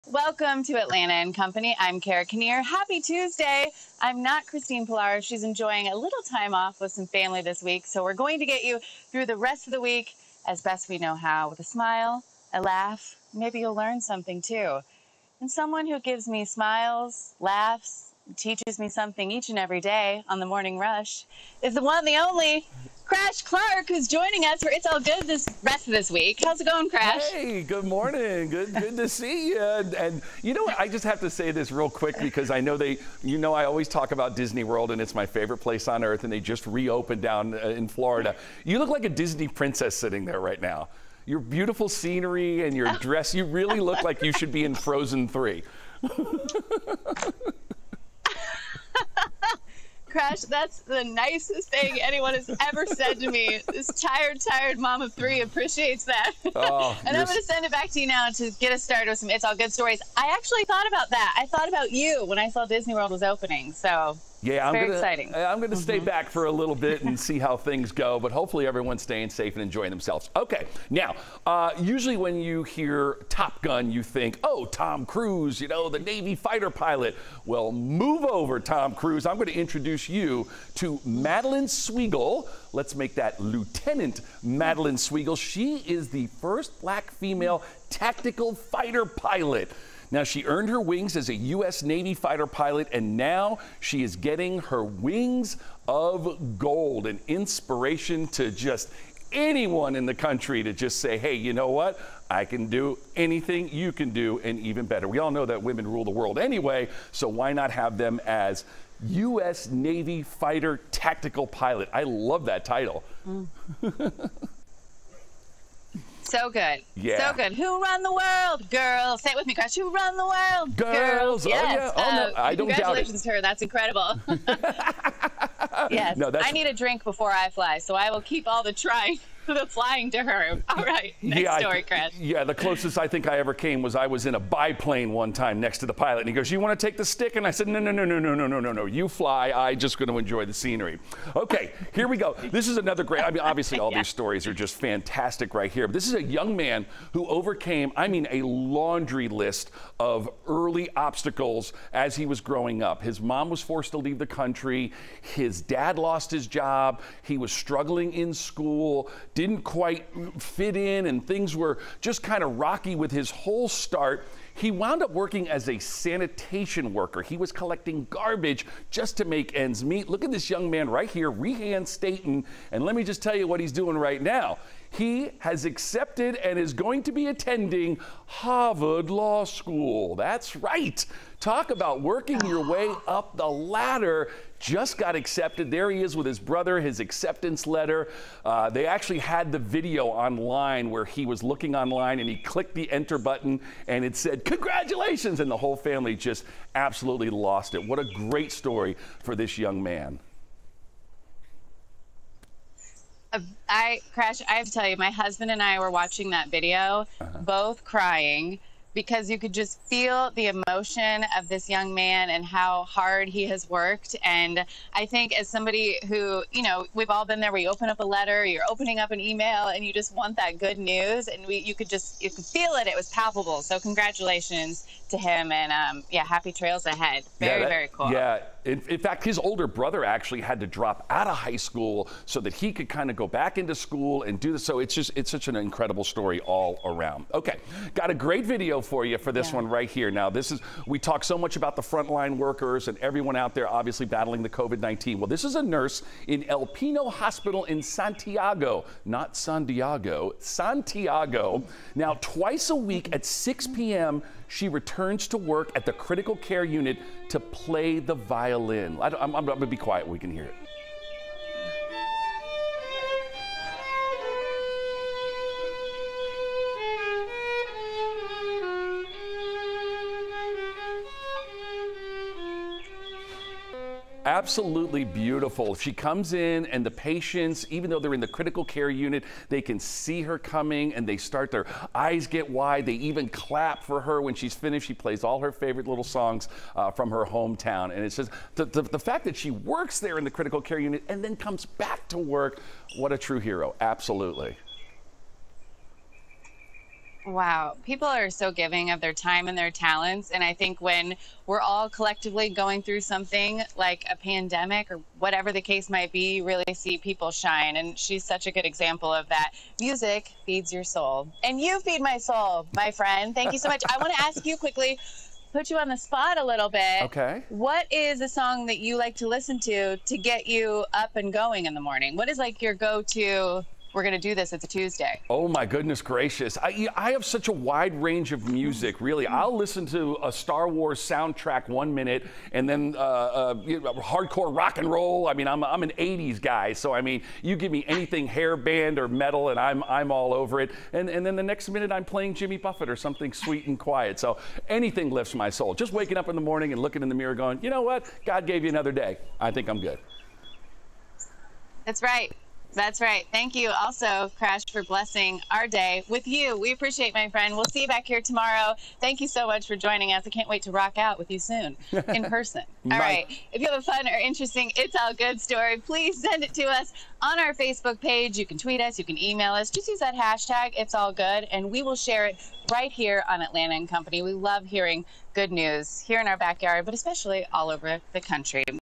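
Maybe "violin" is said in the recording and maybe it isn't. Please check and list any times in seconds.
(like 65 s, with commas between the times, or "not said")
258 s.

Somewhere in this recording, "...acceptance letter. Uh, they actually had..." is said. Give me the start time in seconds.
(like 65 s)
186 s.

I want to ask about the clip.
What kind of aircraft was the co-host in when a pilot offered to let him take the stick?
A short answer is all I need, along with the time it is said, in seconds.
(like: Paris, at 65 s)
A biplane, at 134 s.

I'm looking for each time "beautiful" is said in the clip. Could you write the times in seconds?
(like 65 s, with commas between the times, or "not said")
41 s, 275 s.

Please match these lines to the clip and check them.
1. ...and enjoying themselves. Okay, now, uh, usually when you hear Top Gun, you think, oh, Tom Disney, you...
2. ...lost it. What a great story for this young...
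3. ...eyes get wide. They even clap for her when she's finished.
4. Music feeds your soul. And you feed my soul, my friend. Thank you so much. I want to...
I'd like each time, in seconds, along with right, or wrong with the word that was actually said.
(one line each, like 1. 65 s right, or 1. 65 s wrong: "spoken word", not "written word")
1. 69 s wrong: "Cruise", not "Disney"
2. 197 s right
3. 281 s right
4. 309 s right.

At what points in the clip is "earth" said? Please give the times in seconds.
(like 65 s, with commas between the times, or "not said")
36 s.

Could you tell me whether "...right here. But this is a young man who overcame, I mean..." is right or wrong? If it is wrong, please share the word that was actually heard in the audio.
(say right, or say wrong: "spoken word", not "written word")
right.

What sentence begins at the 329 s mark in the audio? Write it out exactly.
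I'll listen to a Star Wars soundtrack one minute and then uh, uh, hardcore rock and roll.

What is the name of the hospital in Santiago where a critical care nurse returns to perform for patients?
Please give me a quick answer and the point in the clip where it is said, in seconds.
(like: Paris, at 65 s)
El Pino Hospital, at 246 s.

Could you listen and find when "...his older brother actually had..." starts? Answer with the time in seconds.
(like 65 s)
229 s.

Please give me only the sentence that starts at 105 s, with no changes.
We all know that women rule the world anyway, so why not have them as U.S.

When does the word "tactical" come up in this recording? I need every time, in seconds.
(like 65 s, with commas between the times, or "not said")
87 s, 110 s.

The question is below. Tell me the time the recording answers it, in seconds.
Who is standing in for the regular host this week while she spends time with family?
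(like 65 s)
2 s.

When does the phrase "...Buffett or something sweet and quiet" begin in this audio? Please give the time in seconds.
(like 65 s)
342 s.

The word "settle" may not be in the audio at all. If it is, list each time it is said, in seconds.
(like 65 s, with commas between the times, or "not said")
not said.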